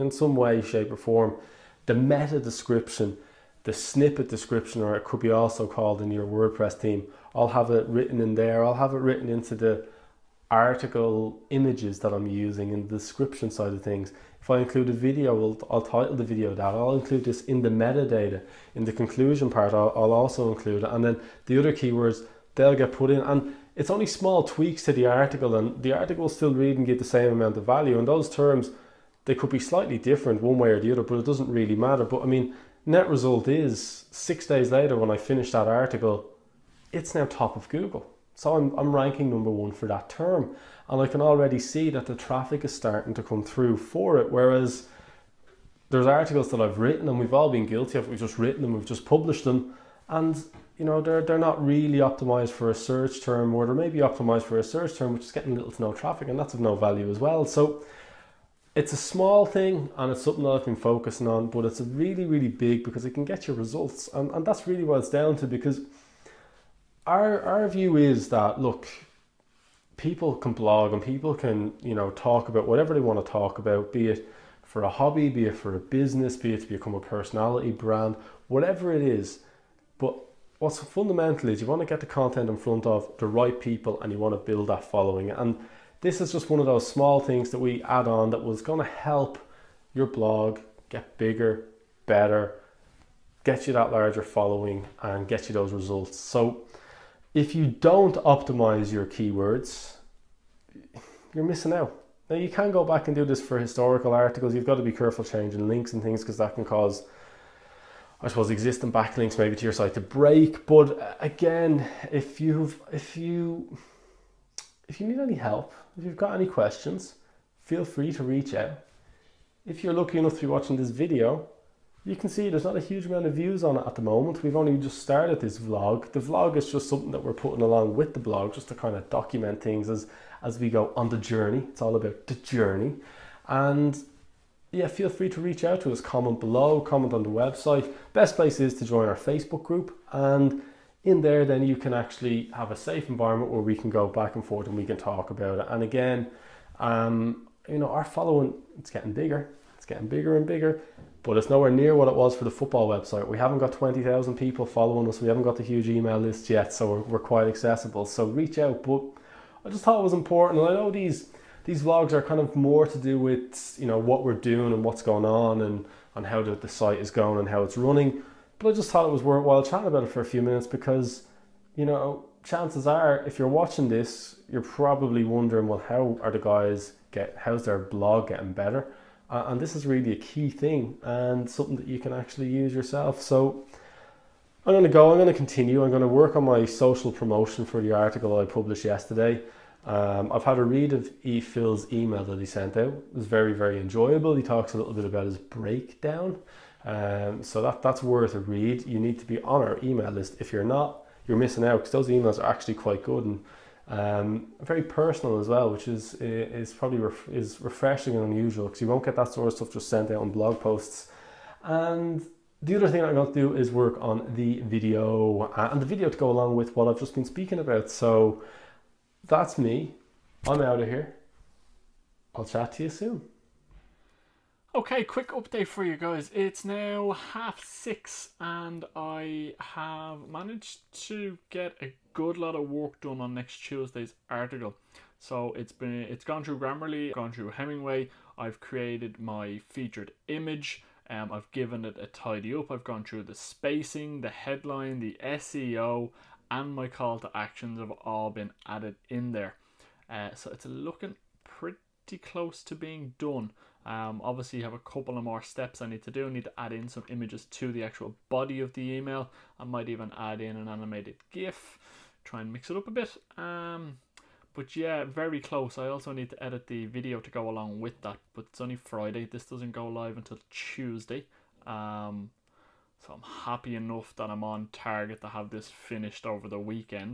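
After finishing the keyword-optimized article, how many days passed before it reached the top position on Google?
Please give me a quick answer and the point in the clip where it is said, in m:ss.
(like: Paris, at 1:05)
6, at 0:34.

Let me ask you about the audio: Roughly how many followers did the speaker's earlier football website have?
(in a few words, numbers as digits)
20,000.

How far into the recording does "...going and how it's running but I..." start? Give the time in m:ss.
2:47.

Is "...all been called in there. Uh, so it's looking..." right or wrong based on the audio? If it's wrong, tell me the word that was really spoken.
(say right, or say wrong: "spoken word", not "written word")
wrong: "added", not "called".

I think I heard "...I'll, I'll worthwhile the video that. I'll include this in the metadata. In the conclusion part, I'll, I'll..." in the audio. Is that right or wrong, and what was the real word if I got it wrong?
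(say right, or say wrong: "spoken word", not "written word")
wrong: "title", not "worthwhile".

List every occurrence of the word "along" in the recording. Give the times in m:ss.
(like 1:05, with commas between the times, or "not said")
2:07, 3:36, 4:27.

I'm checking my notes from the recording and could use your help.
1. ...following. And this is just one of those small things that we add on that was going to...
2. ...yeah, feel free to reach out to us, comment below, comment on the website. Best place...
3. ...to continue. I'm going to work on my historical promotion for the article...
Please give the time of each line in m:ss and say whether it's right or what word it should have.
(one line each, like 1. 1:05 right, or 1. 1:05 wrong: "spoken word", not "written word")
1. 1:24 right
2. 2:14 right
3. 3:05 wrong: "social", not "historical".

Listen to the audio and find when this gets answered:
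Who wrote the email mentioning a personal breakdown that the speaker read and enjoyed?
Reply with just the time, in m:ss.
3:11.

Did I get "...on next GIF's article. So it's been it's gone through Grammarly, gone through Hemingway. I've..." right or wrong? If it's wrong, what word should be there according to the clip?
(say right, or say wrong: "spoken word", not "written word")
wrong: "Tuesday", not "GIF".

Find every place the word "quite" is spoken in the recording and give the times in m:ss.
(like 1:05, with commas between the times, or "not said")
2:37, 3:22.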